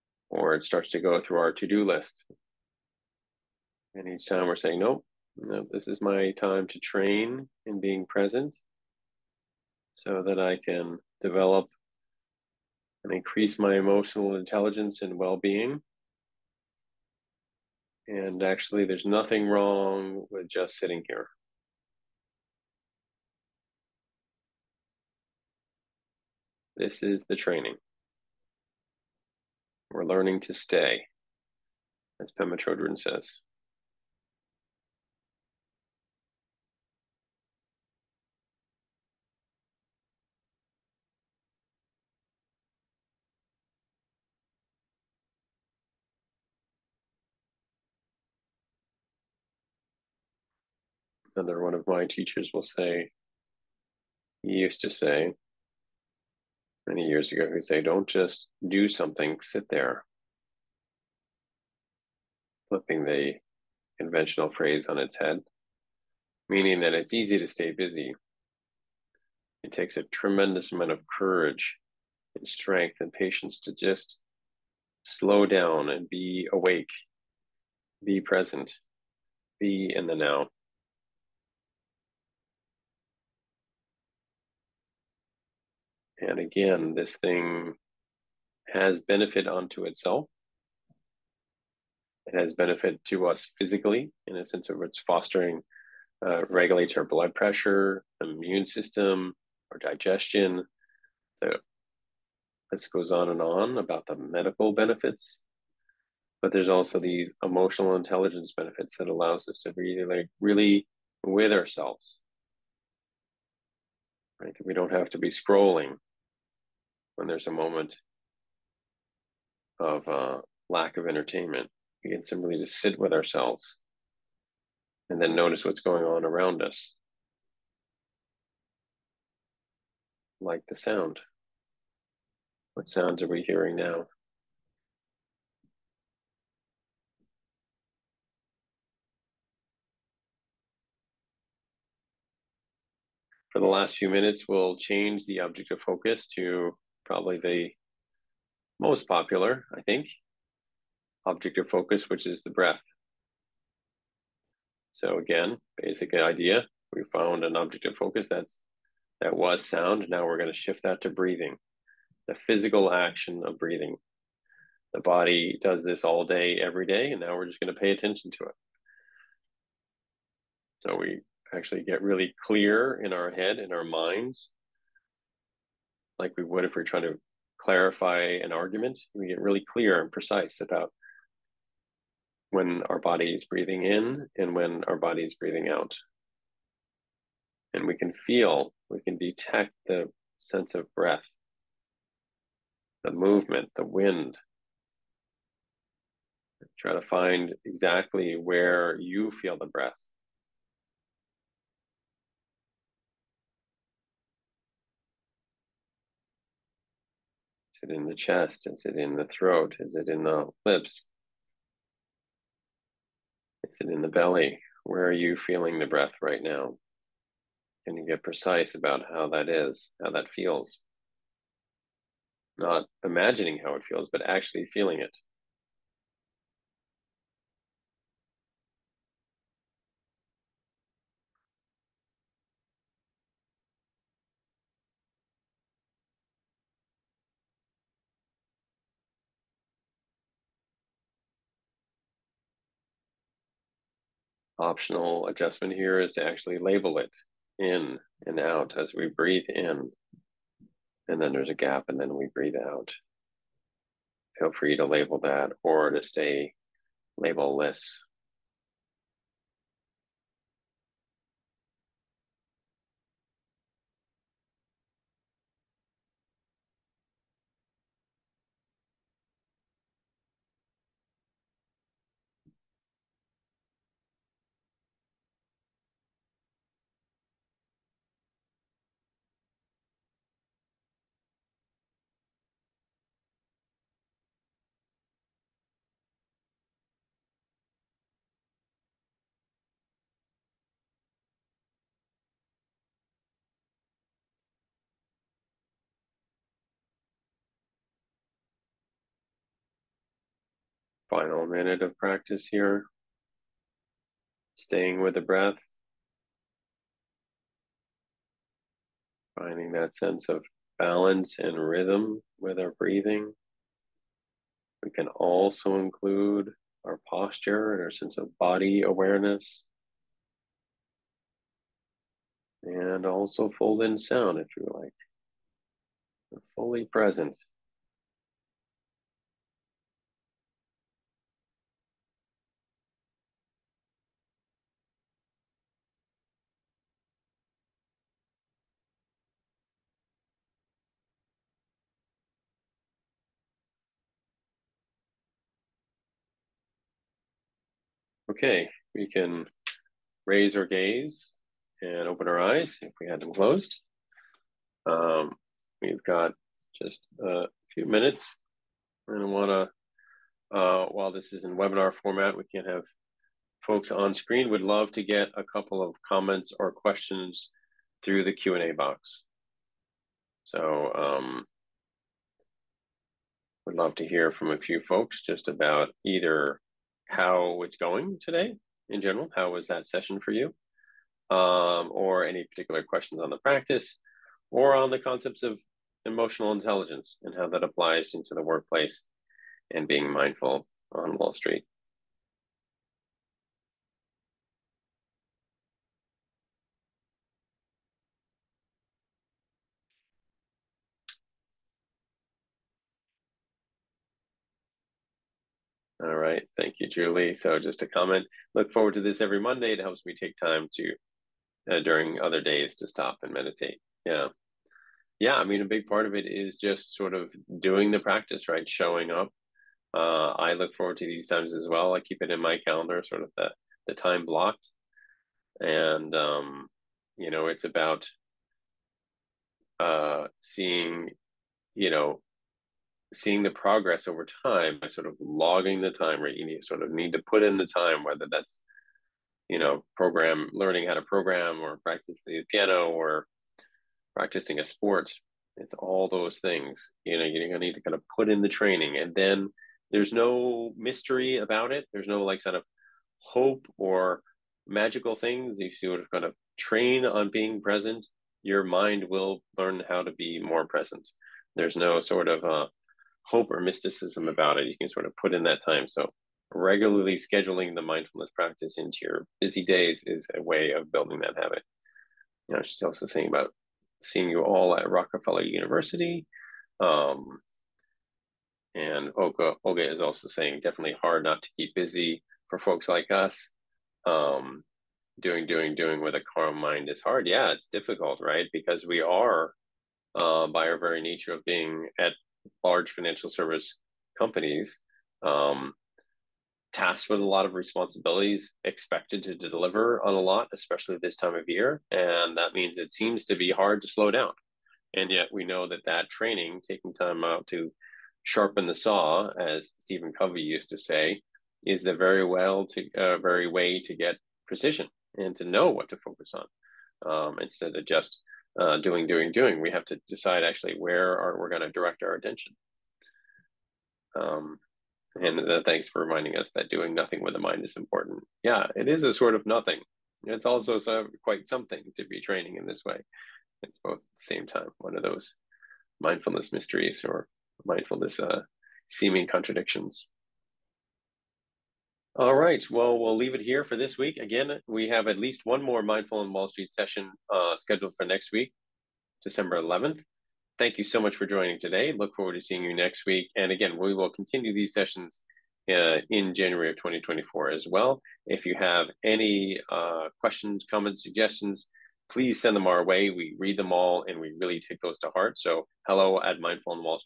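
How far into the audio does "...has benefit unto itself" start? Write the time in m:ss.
1:28.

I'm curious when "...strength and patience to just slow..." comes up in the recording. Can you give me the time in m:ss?
1:12.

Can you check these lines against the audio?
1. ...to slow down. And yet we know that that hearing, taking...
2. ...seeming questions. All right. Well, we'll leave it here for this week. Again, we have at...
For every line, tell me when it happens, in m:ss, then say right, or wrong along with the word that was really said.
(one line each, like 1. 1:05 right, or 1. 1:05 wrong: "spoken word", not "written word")
1. 8:23 wrong: "training", not "hearing"
2. 8:58 wrong: "contradictions", not "questions".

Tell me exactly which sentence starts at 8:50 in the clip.
It's also so, quite something to be training in this way.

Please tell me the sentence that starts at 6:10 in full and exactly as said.
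So, um, would love to hear from a few folks just about either how it's going today in general.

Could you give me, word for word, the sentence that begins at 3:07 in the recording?
And we can feel, we can detect the sense of breath, the movement, the wind.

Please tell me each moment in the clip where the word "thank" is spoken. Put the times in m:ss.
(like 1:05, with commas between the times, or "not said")
6:46, 8:45, 9:10.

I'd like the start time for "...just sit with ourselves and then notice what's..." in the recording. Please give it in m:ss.
2:02.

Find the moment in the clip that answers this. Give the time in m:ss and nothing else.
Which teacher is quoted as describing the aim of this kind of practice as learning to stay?
0:32.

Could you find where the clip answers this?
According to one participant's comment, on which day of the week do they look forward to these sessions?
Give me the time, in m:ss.
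6:49.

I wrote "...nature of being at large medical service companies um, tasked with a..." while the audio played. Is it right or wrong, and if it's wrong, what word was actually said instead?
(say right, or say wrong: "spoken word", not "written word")
wrong: "financial", not "medical".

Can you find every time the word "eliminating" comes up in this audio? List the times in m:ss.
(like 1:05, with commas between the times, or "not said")
not said.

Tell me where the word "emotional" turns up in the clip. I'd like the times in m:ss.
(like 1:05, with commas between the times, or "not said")
0:13, 1:47, 6:26.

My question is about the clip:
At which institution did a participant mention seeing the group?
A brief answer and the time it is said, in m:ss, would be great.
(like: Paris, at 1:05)
Rockefeller University, at 7:54.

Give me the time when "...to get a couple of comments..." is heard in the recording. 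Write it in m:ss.
6:04.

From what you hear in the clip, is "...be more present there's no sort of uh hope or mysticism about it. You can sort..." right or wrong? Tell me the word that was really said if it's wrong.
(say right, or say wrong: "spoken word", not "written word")
right.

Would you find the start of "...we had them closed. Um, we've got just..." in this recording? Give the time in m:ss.
5:53.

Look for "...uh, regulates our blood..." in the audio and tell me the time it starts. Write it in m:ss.
1:36.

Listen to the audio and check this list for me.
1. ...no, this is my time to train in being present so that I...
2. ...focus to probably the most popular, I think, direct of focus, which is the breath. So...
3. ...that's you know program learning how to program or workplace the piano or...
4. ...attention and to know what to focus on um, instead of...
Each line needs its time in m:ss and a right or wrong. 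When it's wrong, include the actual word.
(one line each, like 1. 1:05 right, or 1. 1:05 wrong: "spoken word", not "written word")
1. 0:05 right
2. 2:25 wrong: "object", not "direct"
3. 7:18 wrong: "practice", not "workplace"
4. 8:34 wrong: "precision", not "attention".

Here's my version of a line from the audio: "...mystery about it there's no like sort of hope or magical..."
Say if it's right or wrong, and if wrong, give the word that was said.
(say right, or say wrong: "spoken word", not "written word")
right.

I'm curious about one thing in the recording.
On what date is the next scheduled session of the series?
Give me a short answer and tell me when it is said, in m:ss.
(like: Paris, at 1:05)
December 11th, at 9:09.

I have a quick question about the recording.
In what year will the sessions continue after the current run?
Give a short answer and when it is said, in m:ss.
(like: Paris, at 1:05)
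2024, at 9:16.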